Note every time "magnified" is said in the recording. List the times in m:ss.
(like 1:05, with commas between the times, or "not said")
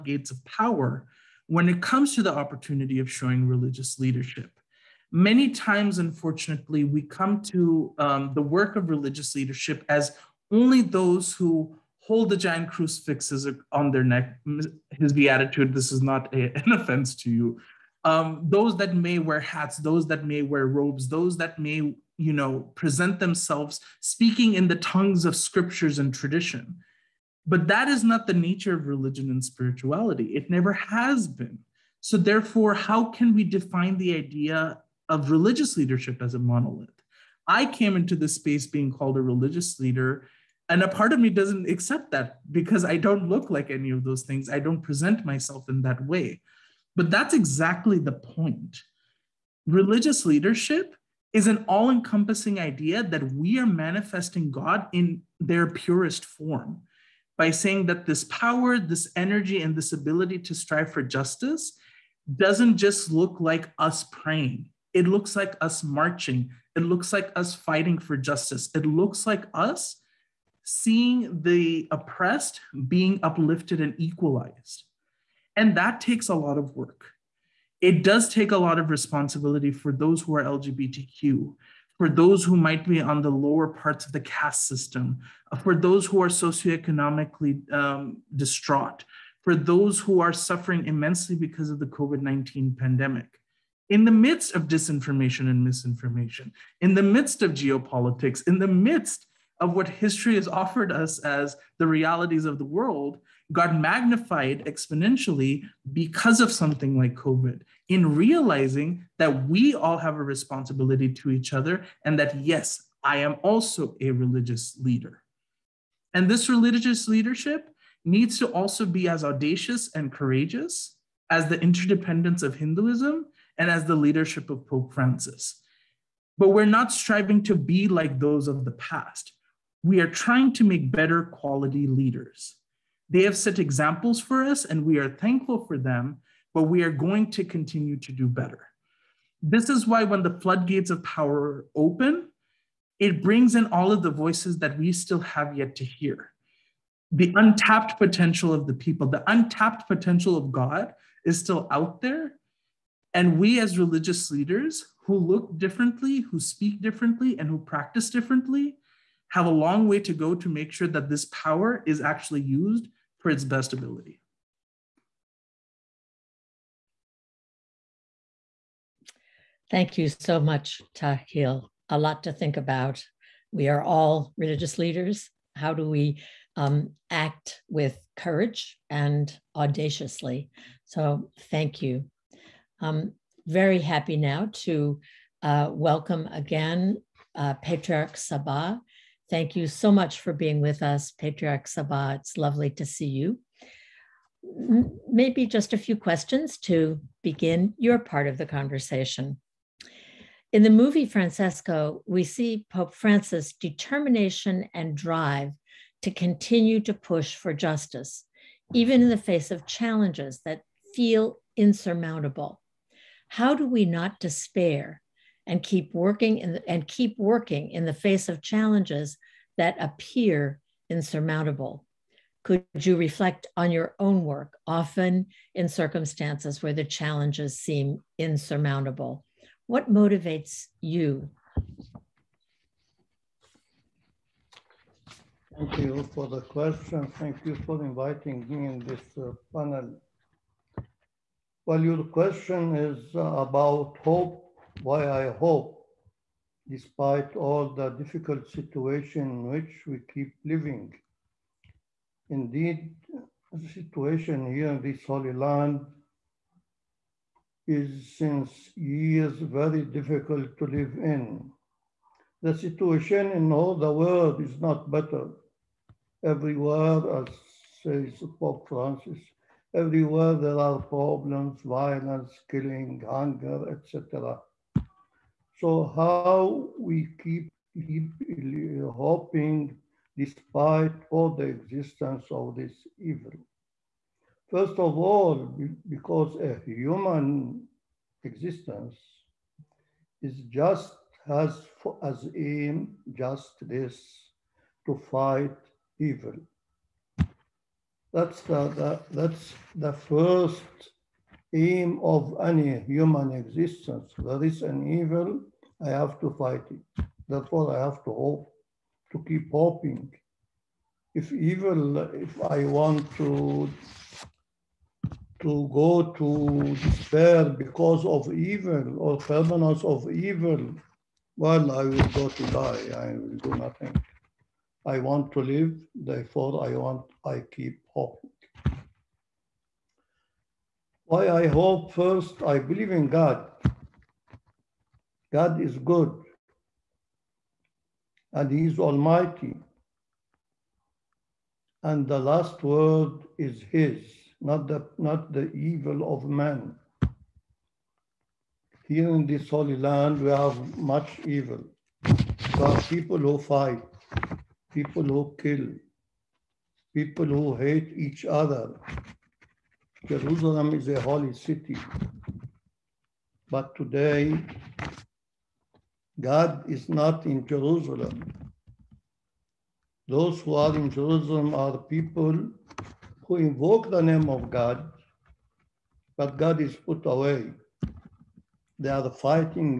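1:43.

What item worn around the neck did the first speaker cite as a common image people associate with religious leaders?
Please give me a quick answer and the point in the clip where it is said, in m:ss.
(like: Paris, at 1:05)
giant crucifixes, at 0:12.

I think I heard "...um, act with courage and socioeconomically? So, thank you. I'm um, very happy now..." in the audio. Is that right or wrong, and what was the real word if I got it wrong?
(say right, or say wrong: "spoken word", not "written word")
wrong: "audaciously", not "socioeconomically".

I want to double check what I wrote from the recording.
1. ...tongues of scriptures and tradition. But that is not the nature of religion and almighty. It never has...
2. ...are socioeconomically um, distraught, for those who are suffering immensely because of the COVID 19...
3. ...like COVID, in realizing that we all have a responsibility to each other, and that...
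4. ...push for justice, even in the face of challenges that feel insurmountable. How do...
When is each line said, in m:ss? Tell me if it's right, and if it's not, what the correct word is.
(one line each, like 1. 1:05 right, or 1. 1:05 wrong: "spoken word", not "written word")
1. 0:24 wrong: "spirituality", not "almighty"
2. 1:26 right
3. 1:46 right
4. 3:26 right.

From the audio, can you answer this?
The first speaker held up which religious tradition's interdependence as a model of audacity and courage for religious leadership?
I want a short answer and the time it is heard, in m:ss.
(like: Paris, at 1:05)
Hinduism, at 2:02.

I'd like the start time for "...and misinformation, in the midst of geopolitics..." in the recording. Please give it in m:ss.
1:35.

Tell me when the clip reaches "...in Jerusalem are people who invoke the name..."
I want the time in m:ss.
6:10.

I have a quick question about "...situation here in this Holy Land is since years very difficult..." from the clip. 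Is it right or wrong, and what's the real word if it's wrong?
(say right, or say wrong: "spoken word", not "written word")
right.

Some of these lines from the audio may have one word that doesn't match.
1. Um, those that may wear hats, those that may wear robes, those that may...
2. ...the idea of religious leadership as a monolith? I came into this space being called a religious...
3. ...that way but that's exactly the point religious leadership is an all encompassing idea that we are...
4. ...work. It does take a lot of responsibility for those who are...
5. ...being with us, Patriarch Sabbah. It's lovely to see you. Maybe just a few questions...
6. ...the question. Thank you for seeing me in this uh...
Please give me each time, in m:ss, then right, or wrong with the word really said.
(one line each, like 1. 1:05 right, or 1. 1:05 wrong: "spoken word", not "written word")
1. 0:18 right
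2. 0:33 right
3. 0:45 right
4. 1:16 right
5. 3:10 right
6. 3:56 wrong: "inviting", not "seeing".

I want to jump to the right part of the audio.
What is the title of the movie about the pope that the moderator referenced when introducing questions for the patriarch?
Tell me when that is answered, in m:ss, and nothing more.
3:21.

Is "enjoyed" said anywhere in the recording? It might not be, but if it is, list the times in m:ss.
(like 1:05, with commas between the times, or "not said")
not said.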